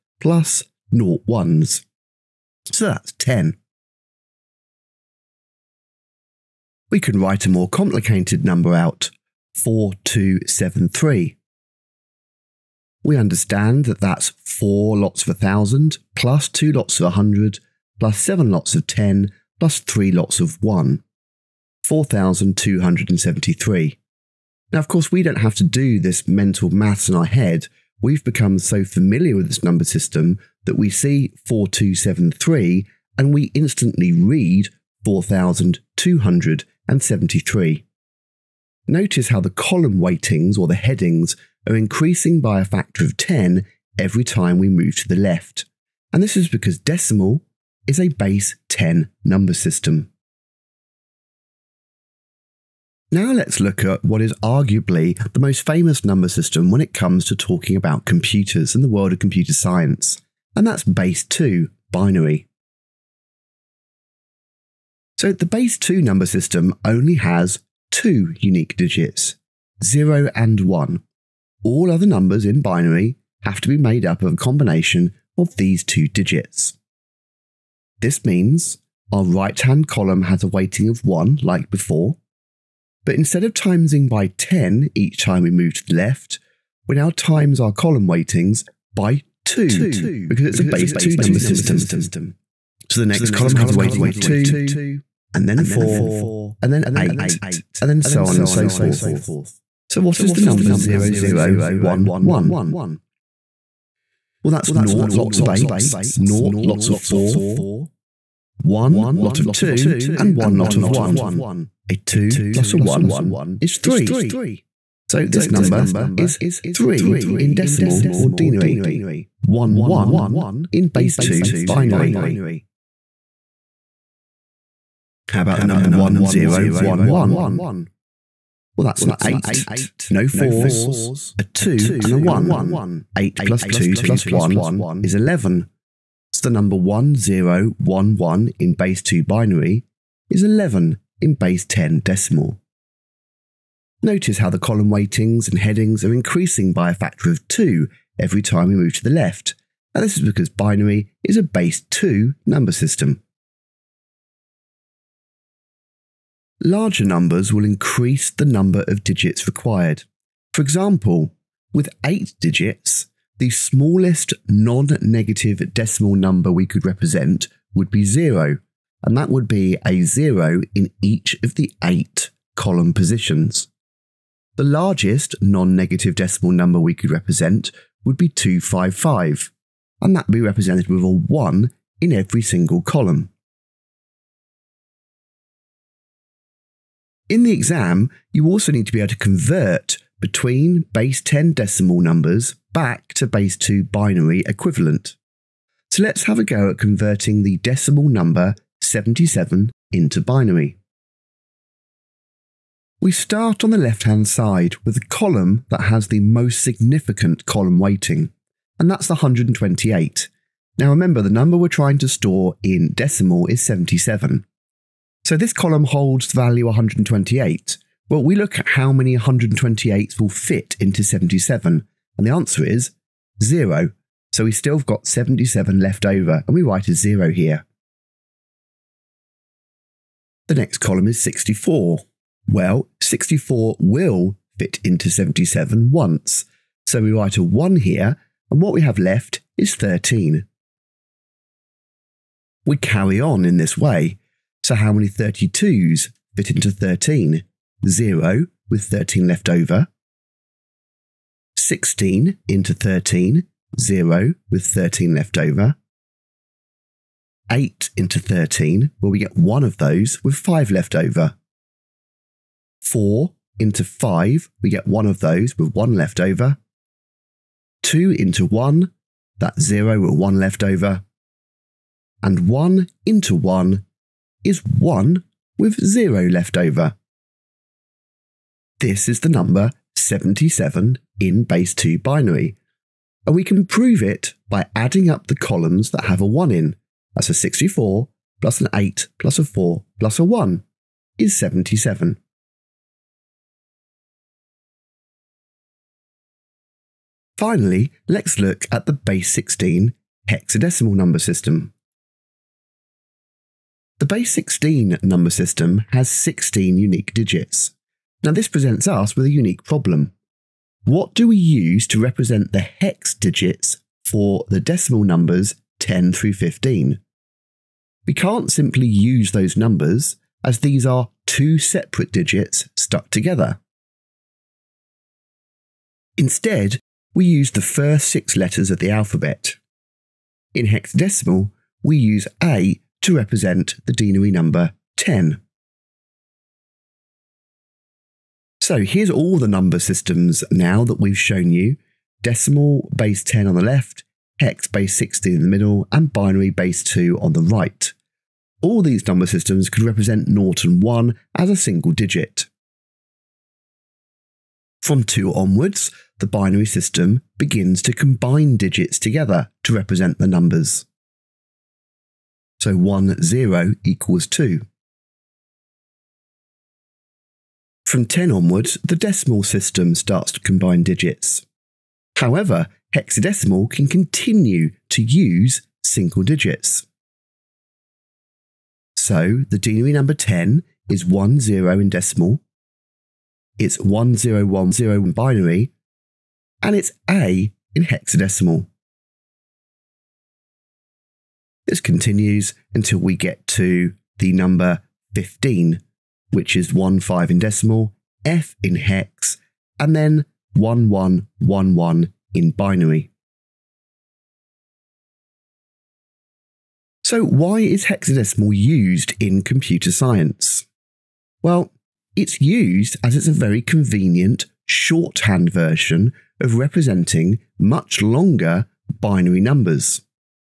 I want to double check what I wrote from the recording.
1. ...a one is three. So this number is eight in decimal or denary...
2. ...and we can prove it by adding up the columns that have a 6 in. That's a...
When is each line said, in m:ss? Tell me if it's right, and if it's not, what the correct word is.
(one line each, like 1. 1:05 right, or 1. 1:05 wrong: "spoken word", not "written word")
1. 1:52 wrong: "three", not "eight"
2. 4:43 wrong: "1", not "6".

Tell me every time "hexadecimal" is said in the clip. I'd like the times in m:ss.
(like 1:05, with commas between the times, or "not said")
5:00, 5:30, 6:12, 6:27, 6:47.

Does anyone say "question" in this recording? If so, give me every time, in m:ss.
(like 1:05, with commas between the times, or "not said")
not said.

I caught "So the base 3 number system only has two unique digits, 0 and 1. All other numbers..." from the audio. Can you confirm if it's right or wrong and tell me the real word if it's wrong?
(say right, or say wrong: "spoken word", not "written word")
wrong: "2", not "3".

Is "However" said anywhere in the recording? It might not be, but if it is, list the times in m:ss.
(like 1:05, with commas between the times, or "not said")
6:12.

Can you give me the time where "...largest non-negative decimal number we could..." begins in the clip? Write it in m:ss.
2:54.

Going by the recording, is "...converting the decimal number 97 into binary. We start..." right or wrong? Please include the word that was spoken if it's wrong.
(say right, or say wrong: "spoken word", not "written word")
wrong: "77", not "97".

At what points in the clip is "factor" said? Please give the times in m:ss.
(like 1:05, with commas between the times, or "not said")
0:42, 2:26.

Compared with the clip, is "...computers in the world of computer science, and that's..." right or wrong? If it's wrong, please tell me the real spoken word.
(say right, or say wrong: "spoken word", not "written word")
right.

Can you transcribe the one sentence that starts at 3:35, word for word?
So this column holds the value 128.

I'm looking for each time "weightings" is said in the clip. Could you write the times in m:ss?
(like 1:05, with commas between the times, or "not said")
0:40, 1:20, 1:28, 1:33, 2:24, 3:27.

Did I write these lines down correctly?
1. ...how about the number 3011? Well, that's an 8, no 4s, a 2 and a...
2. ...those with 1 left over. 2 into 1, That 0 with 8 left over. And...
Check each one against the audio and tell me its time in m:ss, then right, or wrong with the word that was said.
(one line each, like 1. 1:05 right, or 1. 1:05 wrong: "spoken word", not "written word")
1. 2:05 wrong: "1011", not "3011"
2. 4:25 wrong: "1", not "8".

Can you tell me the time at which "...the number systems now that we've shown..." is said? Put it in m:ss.
5:39.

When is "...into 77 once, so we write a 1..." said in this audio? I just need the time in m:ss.
3:54.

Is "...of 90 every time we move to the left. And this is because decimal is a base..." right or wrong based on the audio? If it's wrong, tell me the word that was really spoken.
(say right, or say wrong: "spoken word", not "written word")
wrong: "10", not "90".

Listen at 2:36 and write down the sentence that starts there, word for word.
Larger numbers will increase the number of digits required.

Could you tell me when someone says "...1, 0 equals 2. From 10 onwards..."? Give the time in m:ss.
6:02.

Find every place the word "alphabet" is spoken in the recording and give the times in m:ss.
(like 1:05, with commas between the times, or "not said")
5:28.